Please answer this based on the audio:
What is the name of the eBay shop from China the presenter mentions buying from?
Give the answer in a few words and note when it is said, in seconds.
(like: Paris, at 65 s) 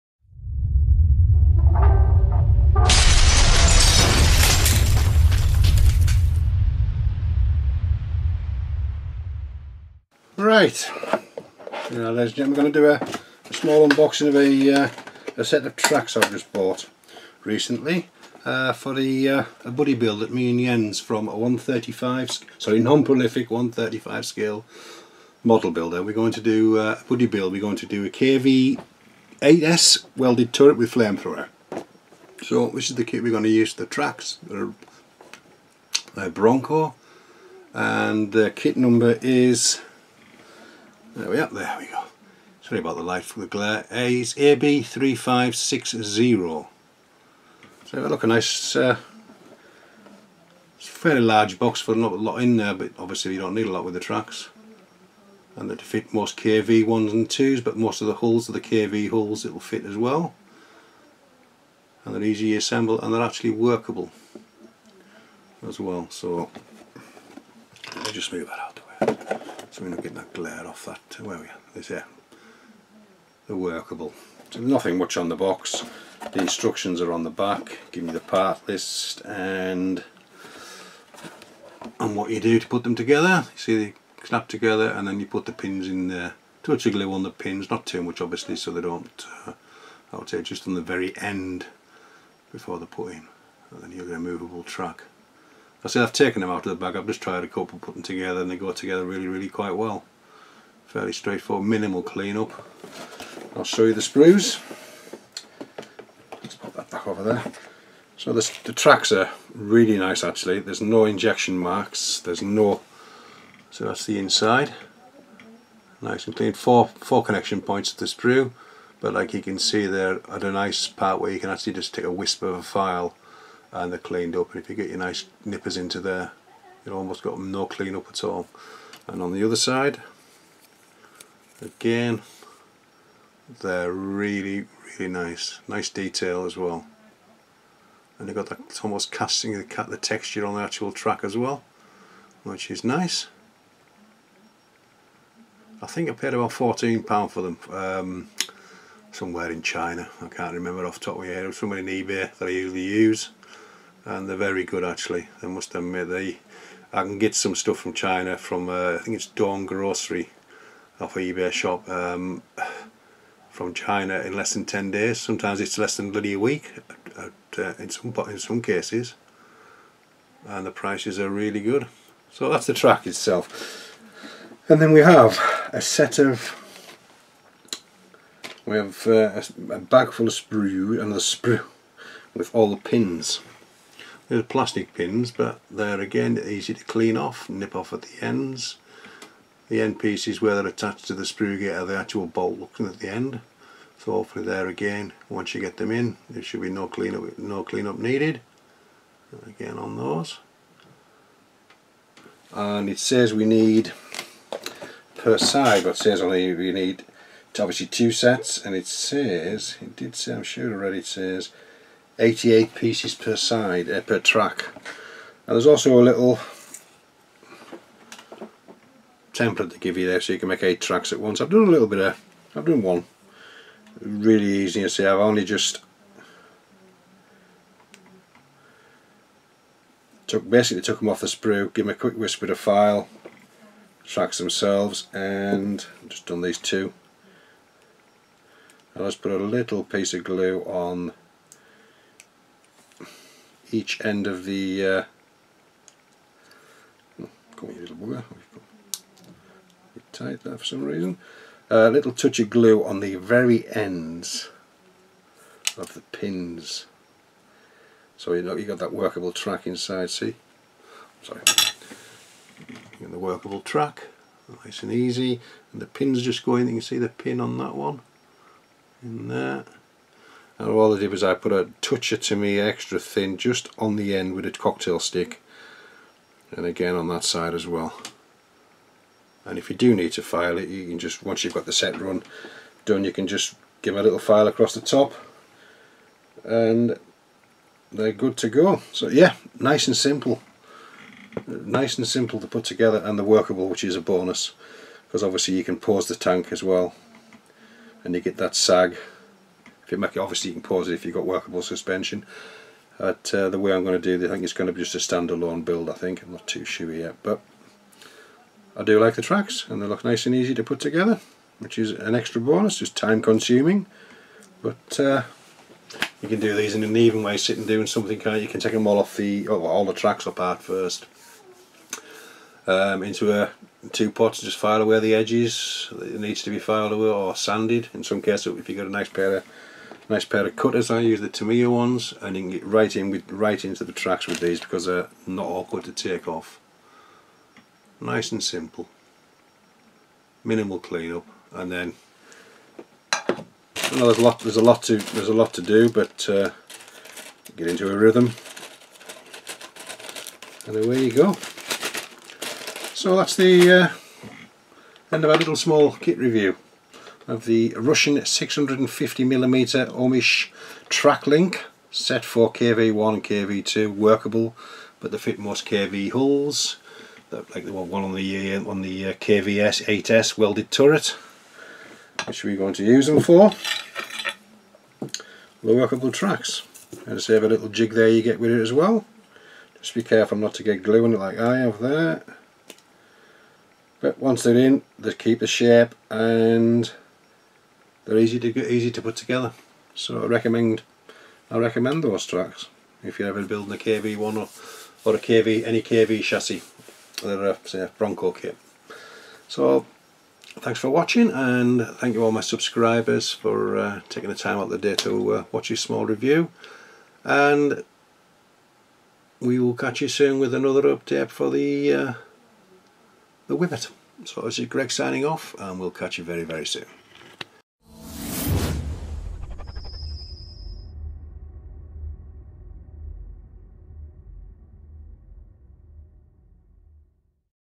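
Dawn Grocery, at 159 s.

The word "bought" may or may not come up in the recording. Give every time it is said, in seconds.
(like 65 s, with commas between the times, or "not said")
16 s.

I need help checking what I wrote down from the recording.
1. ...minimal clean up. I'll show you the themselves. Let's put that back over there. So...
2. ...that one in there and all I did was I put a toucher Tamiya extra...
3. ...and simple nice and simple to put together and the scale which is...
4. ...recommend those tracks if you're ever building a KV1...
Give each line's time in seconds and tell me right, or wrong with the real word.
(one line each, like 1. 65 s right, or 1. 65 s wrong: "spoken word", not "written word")
1. 101 s wrong: "sprues", not "themselves"
2. 267 s right
3. 289 s wrong: "workable", not "scale"
4. 391 s right.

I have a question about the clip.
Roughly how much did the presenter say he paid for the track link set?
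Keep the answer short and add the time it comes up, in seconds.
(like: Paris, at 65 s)
14 pounds, at 146 s.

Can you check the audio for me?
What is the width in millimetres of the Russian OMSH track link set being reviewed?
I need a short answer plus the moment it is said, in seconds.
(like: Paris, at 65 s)
650mm, at 358 s.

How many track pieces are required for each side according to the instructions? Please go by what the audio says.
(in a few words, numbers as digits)
88.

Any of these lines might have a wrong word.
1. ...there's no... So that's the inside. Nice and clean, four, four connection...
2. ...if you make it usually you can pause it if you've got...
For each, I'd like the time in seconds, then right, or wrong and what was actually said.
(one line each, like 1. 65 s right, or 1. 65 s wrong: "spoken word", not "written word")
1. 112 s right
2. 299 s wrong: "obviously", not "usually".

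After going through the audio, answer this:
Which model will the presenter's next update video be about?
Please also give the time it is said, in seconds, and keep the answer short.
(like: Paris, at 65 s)
the Whippet, at 413 s.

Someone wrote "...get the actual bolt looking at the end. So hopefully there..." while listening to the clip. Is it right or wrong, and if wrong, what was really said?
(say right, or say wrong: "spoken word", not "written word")
right.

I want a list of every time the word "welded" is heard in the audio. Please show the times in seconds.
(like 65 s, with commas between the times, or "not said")
30 s, 370 s.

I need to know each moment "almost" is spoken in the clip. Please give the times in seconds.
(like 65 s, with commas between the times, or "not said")
126 s, 138 s.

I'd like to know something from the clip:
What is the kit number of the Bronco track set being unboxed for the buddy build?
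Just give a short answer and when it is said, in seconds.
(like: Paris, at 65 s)
AB3560, at 44 s.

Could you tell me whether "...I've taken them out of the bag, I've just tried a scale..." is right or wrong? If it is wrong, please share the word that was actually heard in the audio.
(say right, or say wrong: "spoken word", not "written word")
wrong: "couple", not "scale".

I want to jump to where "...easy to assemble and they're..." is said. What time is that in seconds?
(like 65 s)
62 s.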